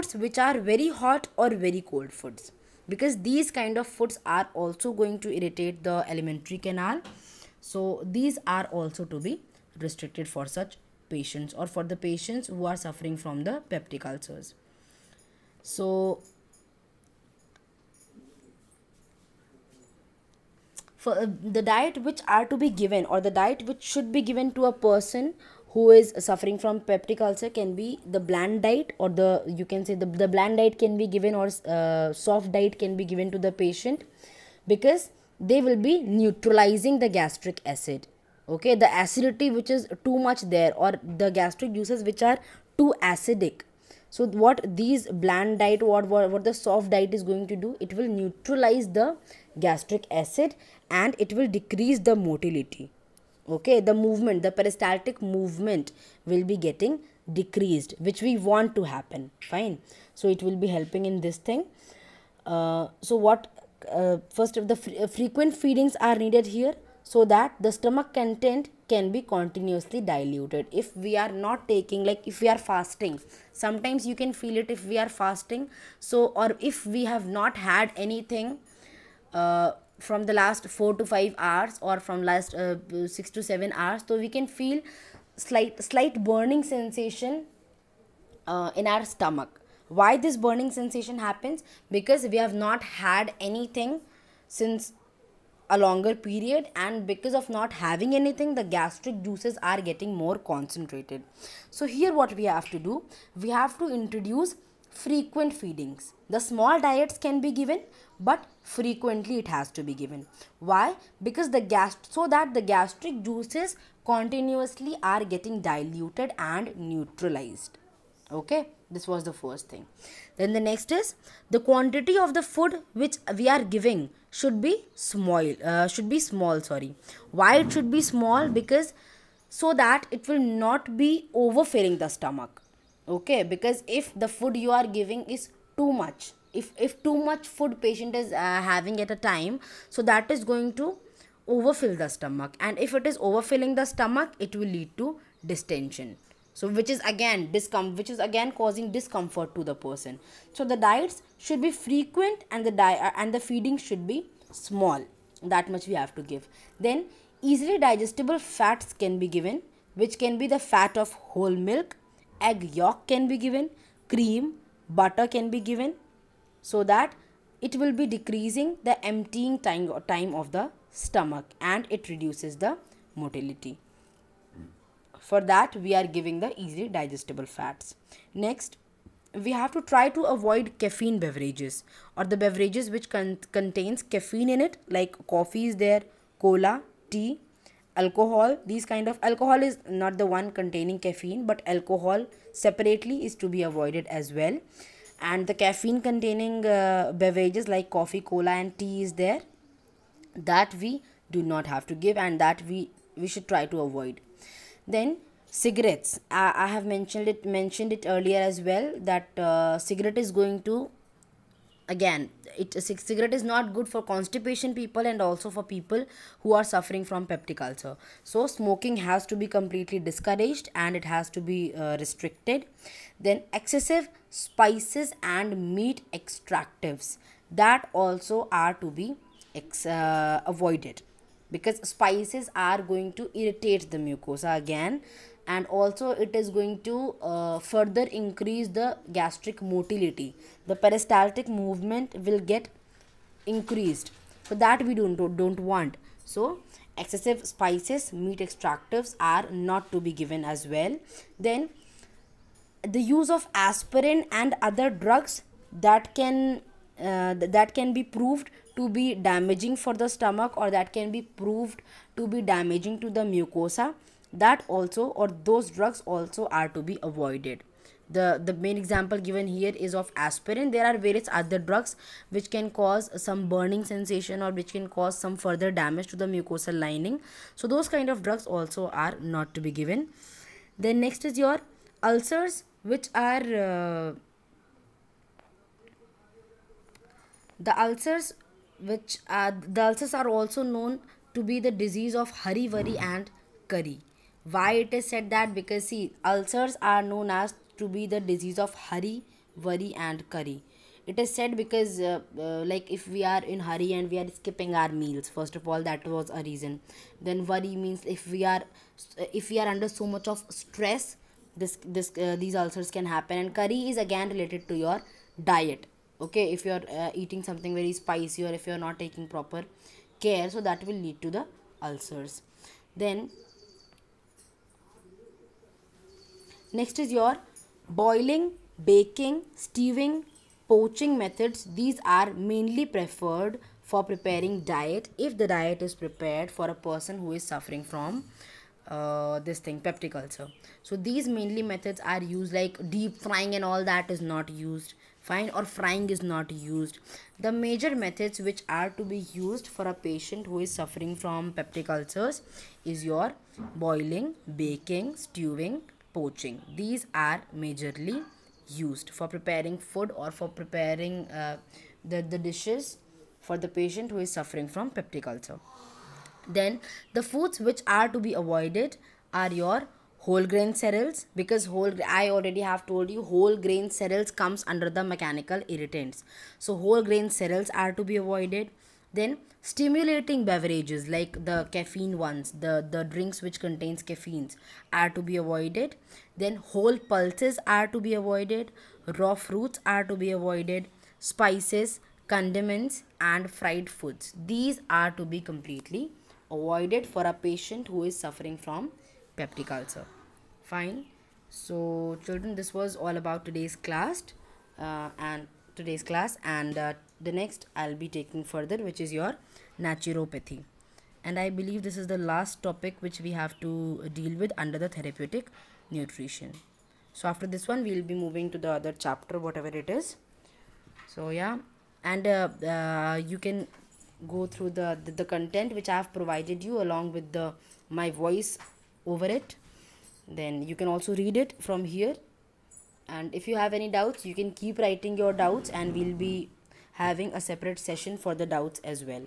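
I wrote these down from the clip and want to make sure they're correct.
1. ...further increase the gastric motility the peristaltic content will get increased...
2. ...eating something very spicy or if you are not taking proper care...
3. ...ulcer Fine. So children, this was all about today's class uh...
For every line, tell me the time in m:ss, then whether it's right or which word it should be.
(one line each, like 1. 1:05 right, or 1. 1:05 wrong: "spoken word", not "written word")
1. 3:57 wrong: "movement", not "content"
2. 5:17 right
3. 6:39 right.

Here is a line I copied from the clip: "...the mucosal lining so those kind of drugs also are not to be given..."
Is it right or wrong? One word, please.
right.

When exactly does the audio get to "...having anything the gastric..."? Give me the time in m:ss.
1:37.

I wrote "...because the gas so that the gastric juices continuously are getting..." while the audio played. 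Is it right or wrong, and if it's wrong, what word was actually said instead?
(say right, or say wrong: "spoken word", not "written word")
right.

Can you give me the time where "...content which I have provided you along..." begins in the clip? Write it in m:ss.
7:05.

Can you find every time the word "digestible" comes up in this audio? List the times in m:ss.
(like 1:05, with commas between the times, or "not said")
2:37, 2:56.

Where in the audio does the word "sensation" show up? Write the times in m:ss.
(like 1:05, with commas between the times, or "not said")
1:26, 1:30, 4:33.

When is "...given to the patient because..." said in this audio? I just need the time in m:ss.
0:33.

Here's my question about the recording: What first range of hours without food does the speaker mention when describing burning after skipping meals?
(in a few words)
4 to 5 hours.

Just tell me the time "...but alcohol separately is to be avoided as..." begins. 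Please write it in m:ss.
3:11.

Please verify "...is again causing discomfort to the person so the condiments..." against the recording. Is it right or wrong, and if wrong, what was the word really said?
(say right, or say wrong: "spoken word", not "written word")
wrong: "diets", not "condiments".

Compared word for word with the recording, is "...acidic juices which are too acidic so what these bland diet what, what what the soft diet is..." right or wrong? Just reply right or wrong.
wrong.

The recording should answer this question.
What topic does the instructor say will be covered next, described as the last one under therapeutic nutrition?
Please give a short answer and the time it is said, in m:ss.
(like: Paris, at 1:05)
Naturopathy, at 6:49.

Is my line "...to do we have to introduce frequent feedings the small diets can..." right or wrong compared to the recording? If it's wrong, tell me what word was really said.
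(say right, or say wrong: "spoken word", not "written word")
right.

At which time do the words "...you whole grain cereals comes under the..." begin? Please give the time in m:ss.
6:13.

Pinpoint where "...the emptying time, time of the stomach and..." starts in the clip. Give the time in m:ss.
2:48.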